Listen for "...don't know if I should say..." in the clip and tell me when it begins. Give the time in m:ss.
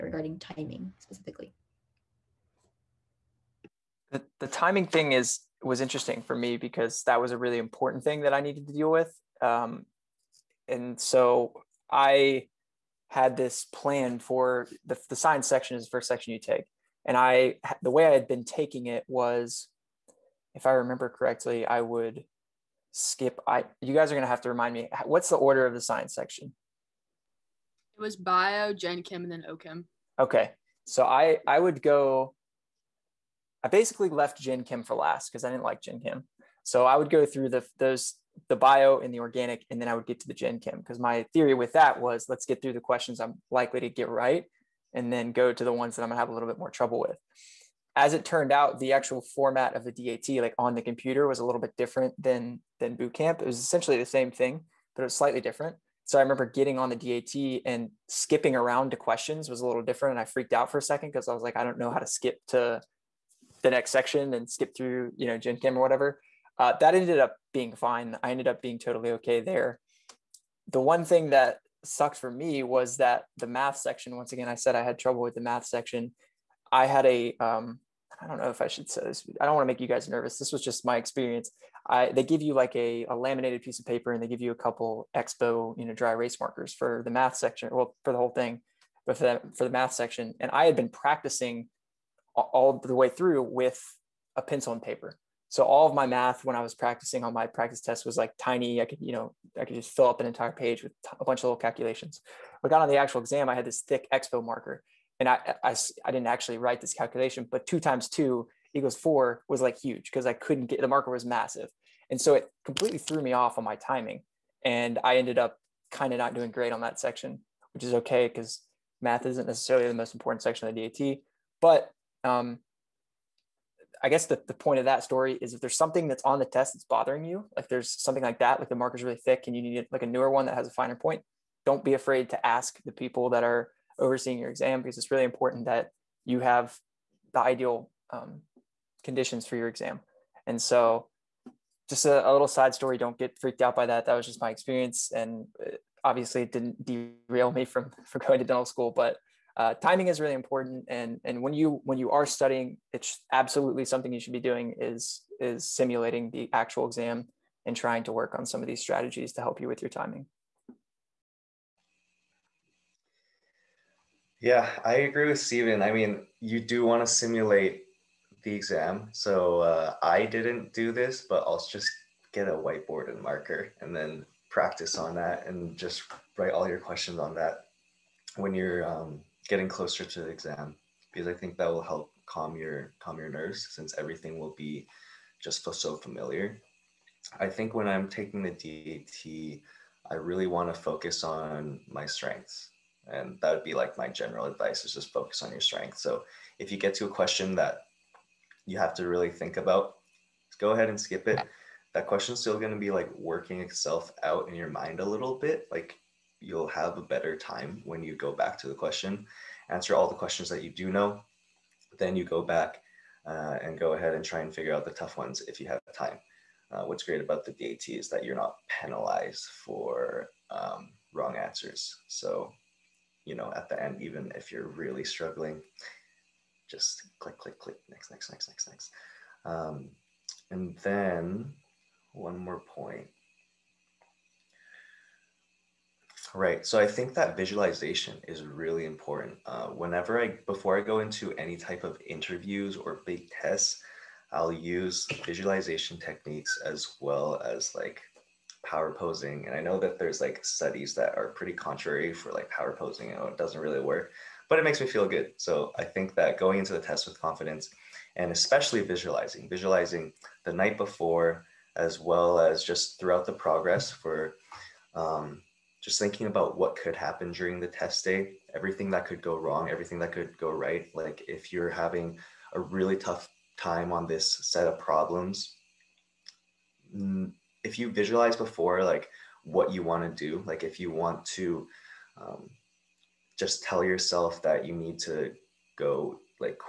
1:18.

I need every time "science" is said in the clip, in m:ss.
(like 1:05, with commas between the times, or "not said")
0:15, 0:25.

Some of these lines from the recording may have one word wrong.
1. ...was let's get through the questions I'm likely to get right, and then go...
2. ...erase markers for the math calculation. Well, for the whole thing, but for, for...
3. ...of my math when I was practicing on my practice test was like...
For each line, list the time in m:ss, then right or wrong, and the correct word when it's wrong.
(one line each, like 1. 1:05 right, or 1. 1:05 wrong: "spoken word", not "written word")
1. 0:42 right
2. 1:26 wrong: "section", not "calculation"
3. 1:35 right.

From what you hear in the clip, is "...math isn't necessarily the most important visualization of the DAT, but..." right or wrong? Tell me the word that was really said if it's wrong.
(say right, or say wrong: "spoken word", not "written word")
wrong: "section", not "visualization".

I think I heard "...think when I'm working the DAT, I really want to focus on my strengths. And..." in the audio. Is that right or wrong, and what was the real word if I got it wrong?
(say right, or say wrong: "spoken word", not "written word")
wrong: "taking", not "working".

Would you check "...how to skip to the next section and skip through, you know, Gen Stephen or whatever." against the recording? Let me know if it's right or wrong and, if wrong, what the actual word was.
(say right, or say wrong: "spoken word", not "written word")
wrong: "Chem", not "Stephen".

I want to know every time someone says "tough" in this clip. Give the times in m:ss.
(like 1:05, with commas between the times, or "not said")
3:34, 4:32.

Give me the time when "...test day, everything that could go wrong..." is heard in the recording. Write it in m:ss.
4:27.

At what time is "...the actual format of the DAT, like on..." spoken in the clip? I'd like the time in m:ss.
0:48.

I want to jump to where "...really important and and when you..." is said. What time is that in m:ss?
2:30.